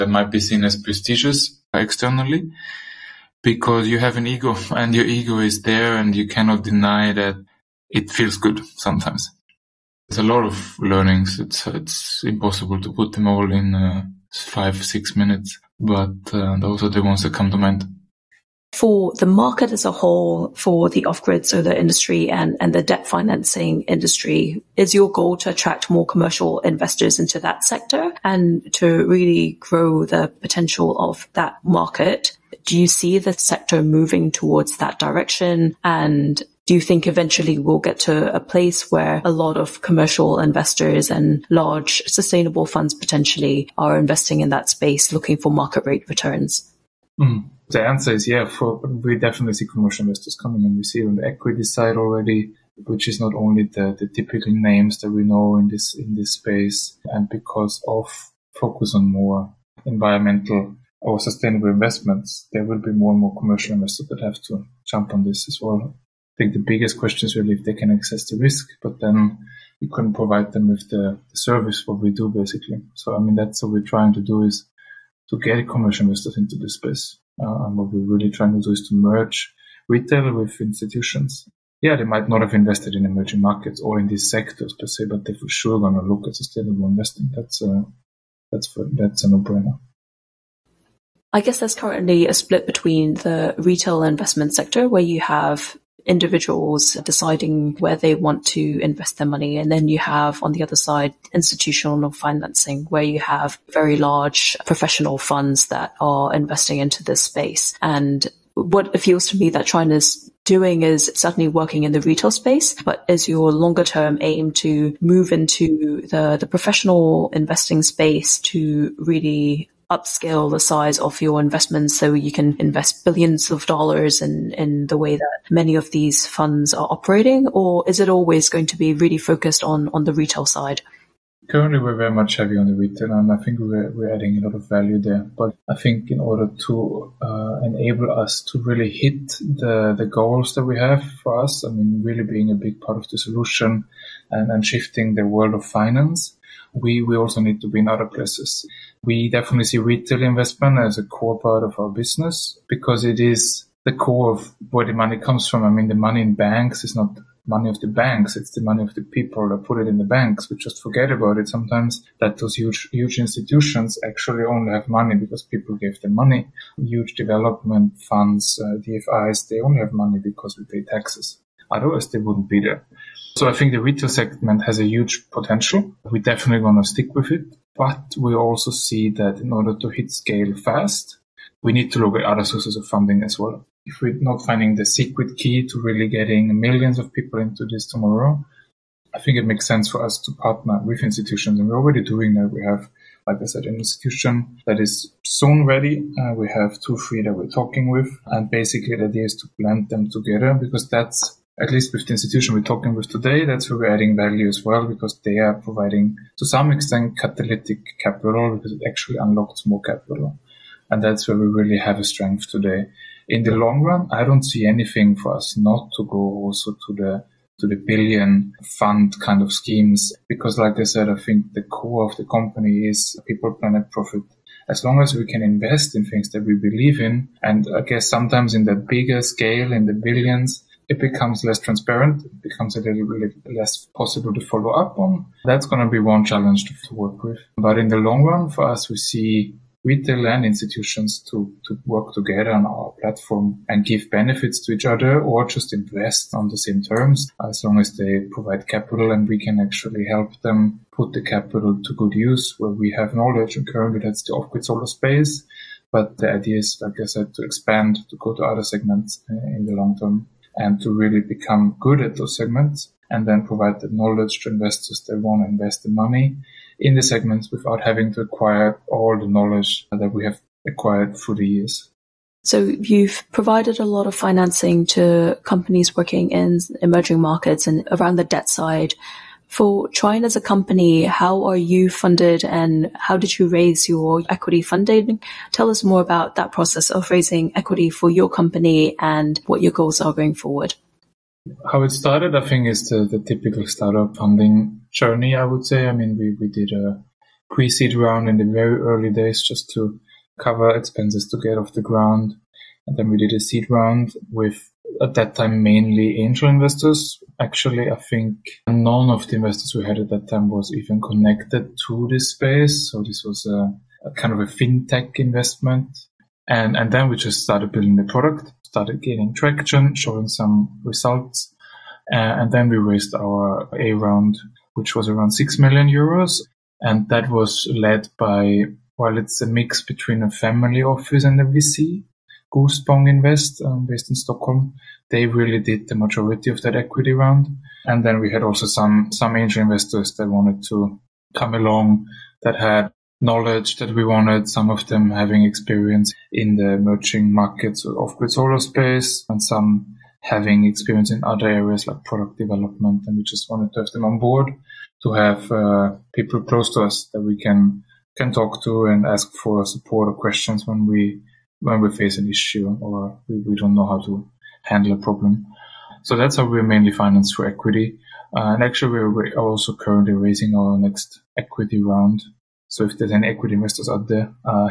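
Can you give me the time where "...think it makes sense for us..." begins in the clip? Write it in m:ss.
3:09.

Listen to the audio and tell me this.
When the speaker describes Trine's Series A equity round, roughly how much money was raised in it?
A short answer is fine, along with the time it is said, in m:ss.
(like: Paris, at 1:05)
6 million euros, at 5:25.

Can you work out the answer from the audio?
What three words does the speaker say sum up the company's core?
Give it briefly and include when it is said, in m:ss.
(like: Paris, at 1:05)
people, planet, profit, at 3:43.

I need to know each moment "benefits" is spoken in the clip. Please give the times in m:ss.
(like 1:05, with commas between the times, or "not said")
4:04.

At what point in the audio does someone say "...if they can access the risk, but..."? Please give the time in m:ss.
1:07.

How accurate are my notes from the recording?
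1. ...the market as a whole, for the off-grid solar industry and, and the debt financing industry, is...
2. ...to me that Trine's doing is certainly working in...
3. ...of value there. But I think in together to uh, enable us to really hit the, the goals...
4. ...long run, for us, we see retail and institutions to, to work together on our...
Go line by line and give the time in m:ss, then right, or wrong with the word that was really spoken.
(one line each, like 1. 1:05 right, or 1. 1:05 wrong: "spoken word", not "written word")
1. 0:19 right
2. 1:49 right
3. 2:14 wrong: "order", not "together"
4. 3:57 right.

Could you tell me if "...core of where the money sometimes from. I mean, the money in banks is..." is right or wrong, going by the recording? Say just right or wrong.
wrong.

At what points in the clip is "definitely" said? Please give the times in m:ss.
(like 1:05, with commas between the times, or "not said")
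0:49, 2:29, 2:56.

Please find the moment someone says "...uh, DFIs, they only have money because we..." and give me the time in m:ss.
2:48.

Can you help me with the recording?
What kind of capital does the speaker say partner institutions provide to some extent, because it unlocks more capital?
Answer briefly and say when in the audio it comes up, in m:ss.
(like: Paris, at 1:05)
catalytic capital, at 3:27.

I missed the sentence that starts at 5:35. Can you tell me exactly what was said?
They really did the majority of that equity round.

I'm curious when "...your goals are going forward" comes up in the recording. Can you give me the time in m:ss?
4:49.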